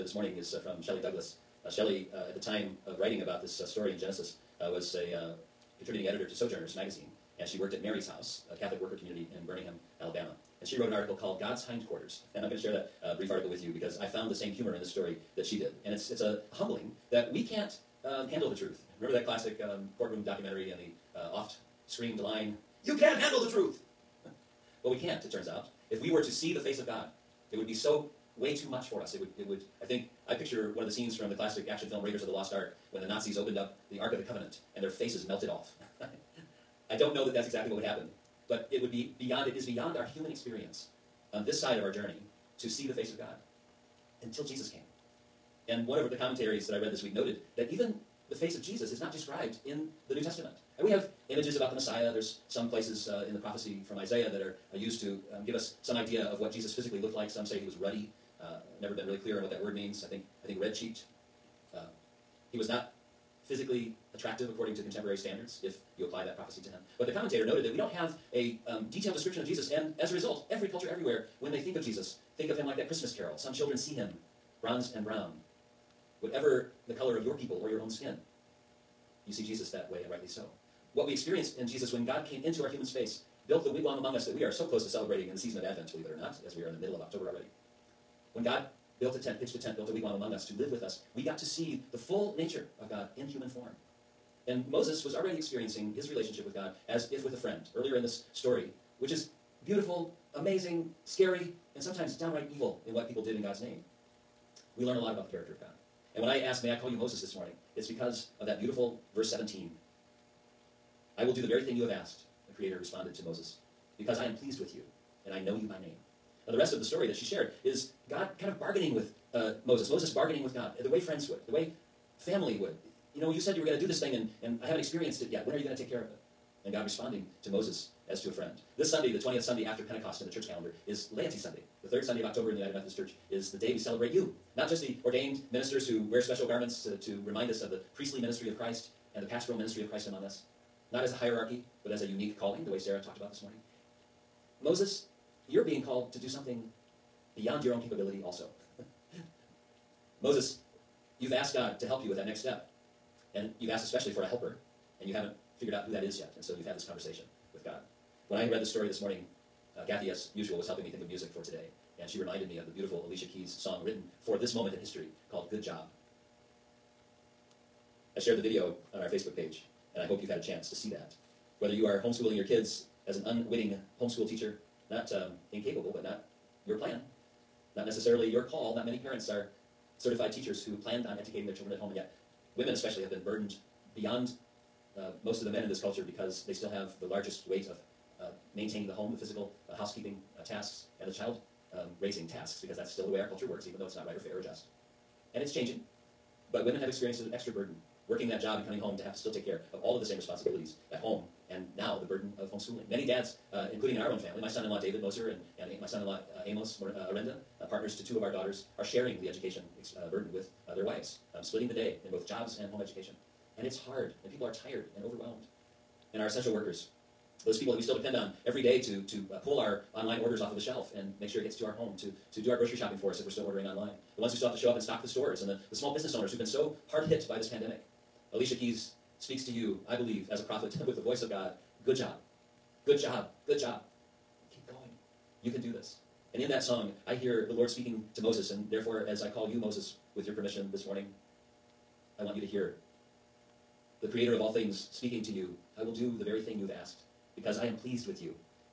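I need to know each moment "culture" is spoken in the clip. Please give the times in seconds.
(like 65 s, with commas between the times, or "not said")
70 s, 185 s, 193 s.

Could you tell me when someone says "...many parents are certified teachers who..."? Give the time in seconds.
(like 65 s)
178 s.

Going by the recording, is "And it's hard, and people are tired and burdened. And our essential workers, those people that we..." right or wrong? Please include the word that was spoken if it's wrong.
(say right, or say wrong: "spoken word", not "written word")
wrong: "overwhelmed", not "burdened".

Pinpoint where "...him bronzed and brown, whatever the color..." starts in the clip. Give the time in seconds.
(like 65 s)
73 s.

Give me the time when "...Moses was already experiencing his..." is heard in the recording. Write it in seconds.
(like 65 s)
94 s.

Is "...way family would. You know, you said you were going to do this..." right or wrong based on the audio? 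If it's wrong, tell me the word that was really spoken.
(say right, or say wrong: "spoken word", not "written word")
right.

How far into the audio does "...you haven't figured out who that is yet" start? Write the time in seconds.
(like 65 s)
155 s.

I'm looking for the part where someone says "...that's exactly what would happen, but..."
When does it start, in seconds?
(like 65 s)
37 s.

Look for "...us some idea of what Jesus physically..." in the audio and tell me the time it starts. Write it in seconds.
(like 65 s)
55 s.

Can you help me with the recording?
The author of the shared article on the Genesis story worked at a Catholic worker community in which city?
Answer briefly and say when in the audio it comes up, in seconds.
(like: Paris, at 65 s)
Birmingham, Alabama, at 9 s.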